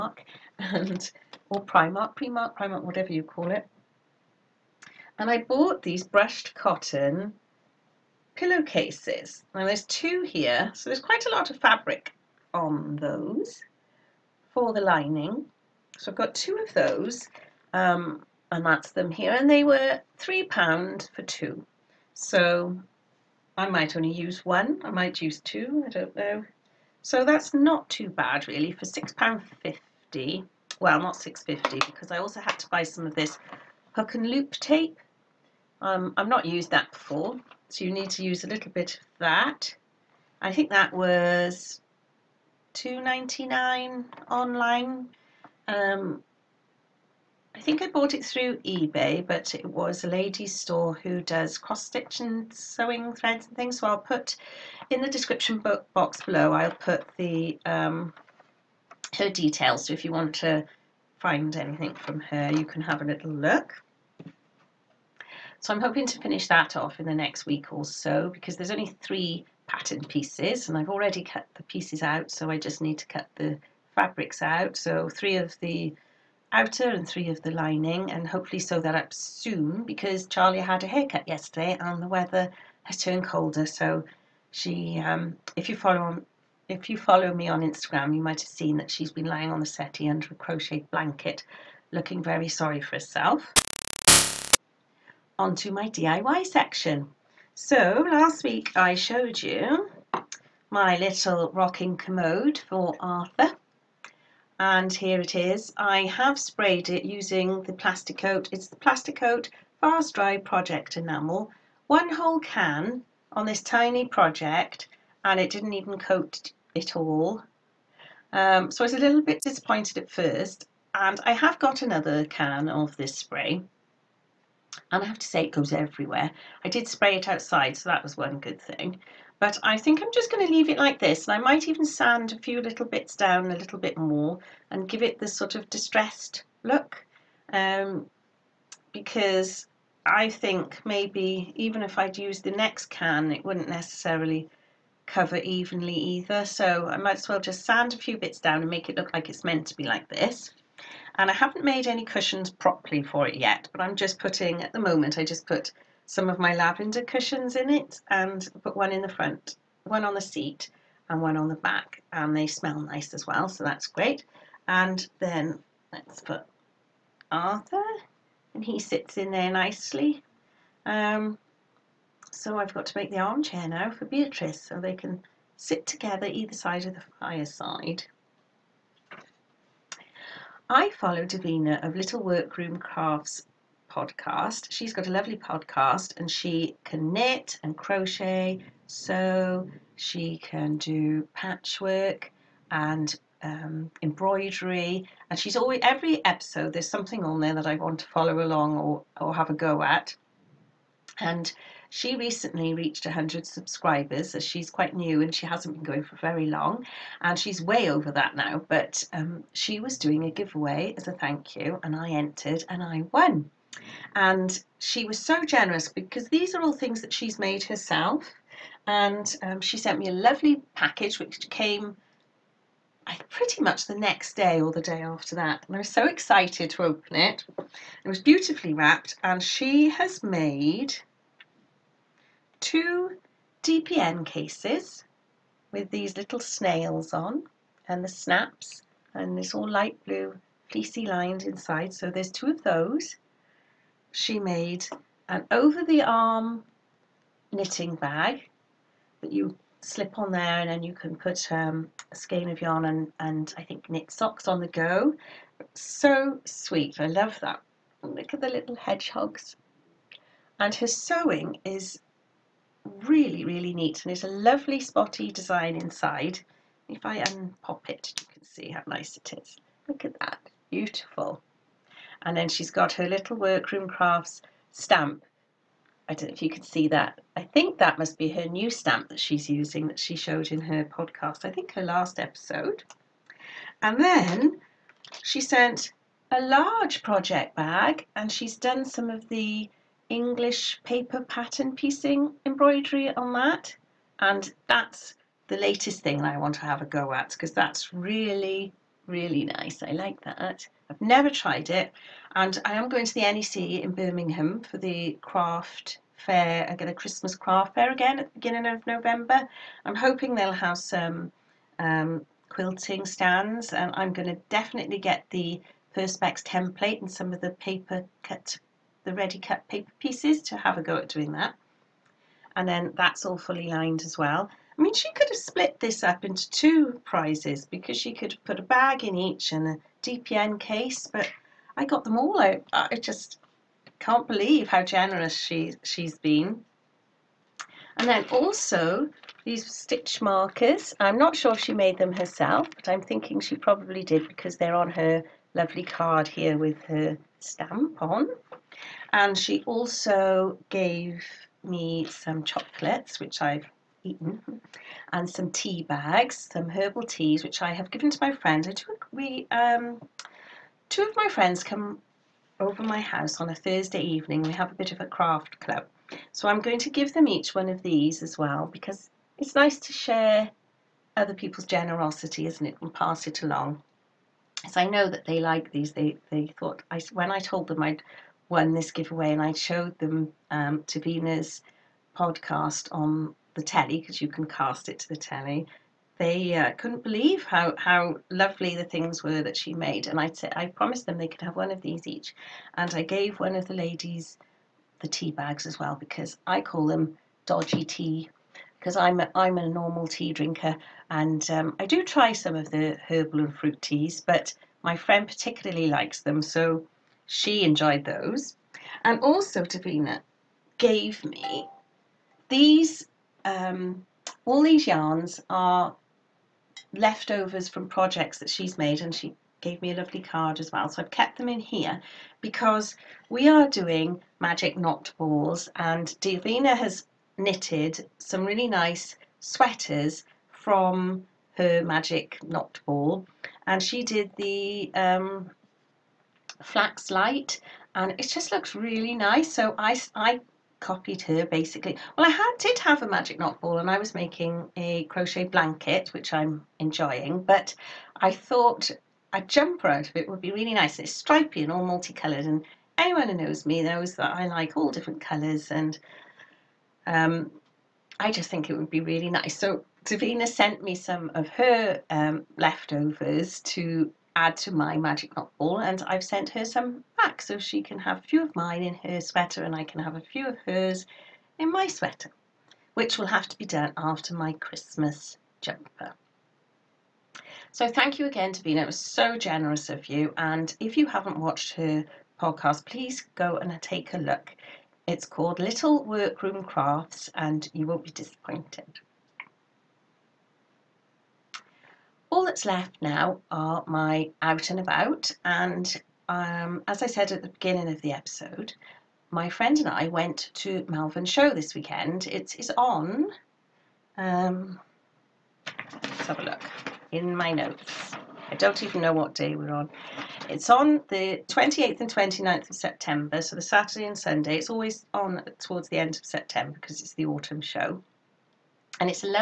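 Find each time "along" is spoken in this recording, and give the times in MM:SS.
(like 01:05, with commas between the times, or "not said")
03:18, 06:13.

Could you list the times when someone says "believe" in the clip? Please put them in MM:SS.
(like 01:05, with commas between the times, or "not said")
05:34, 06:27.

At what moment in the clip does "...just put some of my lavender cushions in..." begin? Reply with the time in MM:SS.
02:35.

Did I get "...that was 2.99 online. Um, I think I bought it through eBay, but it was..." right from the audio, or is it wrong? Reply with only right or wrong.
right.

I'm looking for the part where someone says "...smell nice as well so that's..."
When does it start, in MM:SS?
02:42.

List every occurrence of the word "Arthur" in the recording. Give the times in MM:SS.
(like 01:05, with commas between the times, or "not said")
01:43, 02:47.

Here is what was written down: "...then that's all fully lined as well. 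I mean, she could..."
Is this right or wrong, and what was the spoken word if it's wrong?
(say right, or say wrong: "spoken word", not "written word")
right.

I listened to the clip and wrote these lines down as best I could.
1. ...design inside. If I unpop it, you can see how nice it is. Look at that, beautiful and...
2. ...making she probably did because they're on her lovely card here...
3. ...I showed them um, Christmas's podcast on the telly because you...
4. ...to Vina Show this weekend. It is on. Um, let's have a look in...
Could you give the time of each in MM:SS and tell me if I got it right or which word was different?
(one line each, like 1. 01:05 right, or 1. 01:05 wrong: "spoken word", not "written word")
1. 04:25 right
2. 05:43 wrong: "thinking", not "making"
3. 06:19 wrong: "Davina", not "Christmas"
4. 08:20 wrong: "Malvern", not "Vina".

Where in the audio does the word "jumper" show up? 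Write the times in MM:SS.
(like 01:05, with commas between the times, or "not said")
07:29, 07:55.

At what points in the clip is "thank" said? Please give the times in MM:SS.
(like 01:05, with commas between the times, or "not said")
03:31, 07:57.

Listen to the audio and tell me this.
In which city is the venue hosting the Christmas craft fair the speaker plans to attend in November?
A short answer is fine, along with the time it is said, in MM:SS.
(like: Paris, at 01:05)
Birmingham, at 05:03.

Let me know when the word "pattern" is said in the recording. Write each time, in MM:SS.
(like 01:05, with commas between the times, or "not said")
01:09, 04:51.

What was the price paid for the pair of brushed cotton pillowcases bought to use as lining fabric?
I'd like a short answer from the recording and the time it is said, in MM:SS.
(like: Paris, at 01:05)
£3, at 00:20.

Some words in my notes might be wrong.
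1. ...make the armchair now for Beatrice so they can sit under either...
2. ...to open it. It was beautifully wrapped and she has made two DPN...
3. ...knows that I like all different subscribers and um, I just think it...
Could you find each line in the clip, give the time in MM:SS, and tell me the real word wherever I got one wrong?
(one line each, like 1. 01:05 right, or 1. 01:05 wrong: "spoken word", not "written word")
1. 02:52 wrong: "together", not "under"
2. 03:46 right
3. 07:33 wrong: "colours", not "subscribers".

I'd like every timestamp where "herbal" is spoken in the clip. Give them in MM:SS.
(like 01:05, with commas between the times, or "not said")
05:56, 06:43.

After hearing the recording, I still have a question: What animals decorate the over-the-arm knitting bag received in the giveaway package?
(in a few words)
Hedgehogs.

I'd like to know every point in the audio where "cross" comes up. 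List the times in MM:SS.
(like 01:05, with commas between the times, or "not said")
00:51.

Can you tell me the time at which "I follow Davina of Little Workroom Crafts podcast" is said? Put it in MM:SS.
03:00.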